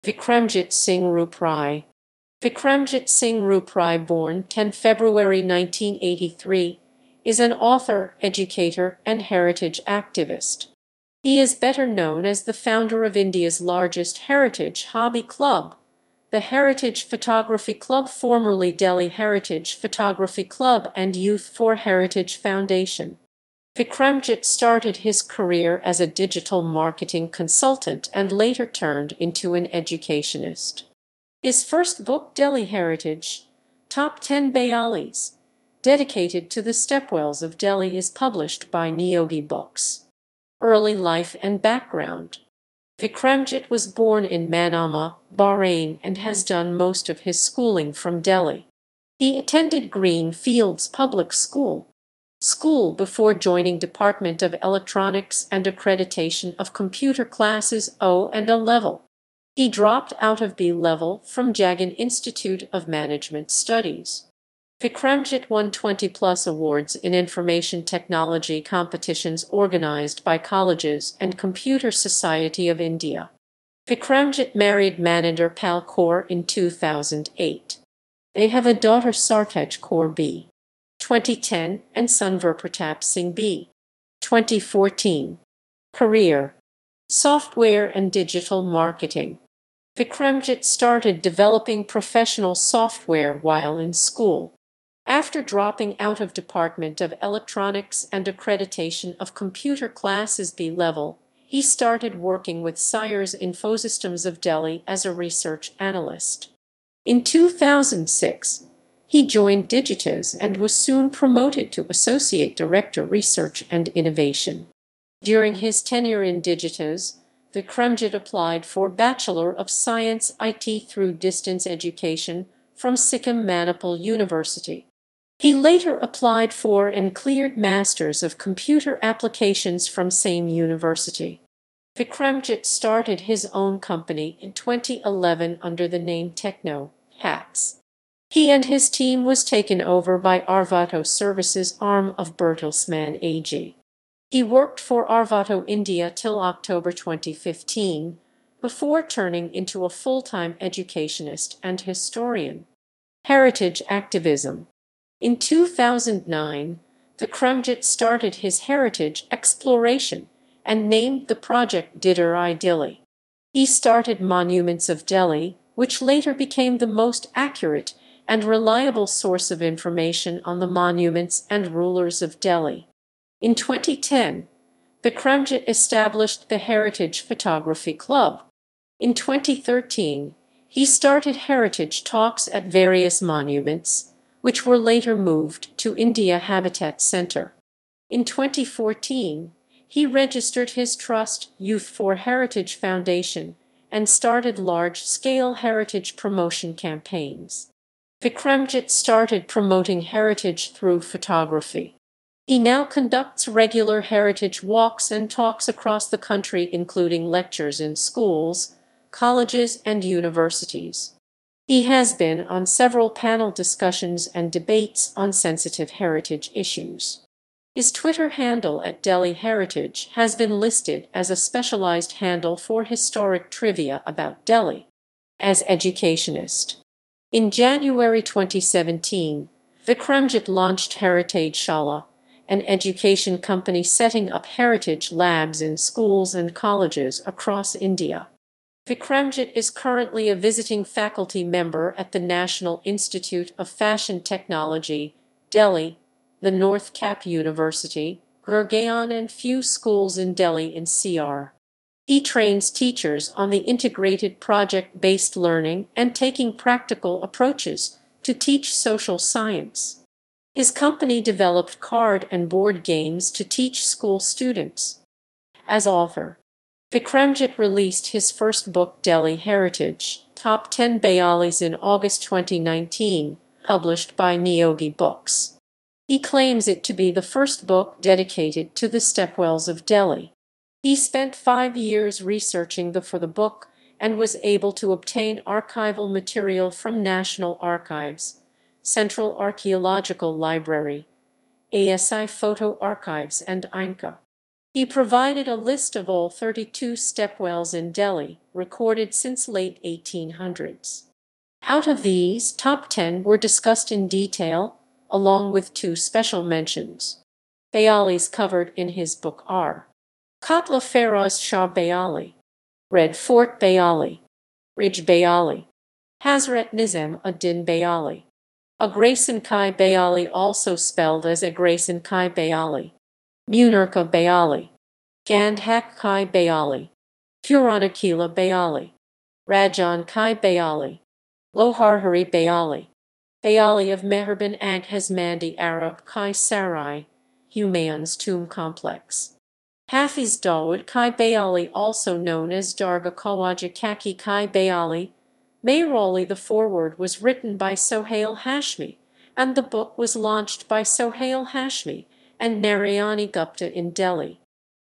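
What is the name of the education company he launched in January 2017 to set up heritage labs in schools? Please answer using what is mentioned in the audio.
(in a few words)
Heritage Shala.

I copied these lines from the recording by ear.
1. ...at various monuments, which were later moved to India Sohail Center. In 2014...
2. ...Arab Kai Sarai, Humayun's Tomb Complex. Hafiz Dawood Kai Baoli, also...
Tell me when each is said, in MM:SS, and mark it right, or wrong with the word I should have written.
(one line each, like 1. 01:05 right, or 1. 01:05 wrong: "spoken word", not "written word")
1. 03:02 wrong: "Habitat", not "Sohail"
2. 05:35 right.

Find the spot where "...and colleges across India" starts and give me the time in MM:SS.
03:56.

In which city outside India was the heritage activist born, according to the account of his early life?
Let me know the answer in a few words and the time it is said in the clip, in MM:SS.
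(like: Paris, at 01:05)
Manama, Bahrain, at 00:44.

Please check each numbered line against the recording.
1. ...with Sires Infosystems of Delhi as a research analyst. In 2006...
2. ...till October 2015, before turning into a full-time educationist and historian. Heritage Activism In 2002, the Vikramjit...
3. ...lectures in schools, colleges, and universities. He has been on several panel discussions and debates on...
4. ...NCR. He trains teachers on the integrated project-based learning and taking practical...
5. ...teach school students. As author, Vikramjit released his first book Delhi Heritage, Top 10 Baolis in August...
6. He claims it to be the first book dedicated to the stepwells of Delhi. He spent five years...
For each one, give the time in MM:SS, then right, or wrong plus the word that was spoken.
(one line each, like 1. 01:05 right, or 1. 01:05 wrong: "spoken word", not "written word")
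1. 01:42 right
2. 02:26 wrong: "2009", not "2002"
3. 03:27 right
4. 04:10 right
5. 04:23 right
6. 04:36 right.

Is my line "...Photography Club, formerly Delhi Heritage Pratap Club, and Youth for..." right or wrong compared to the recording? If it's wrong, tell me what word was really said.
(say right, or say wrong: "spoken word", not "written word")
wrong: "Photography", not "Pratap".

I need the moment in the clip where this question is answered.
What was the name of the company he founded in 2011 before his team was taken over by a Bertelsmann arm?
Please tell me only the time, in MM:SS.
02:16.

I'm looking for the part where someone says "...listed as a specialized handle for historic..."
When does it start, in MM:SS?
03:40.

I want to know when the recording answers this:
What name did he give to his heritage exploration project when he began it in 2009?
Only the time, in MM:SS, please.
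02:41.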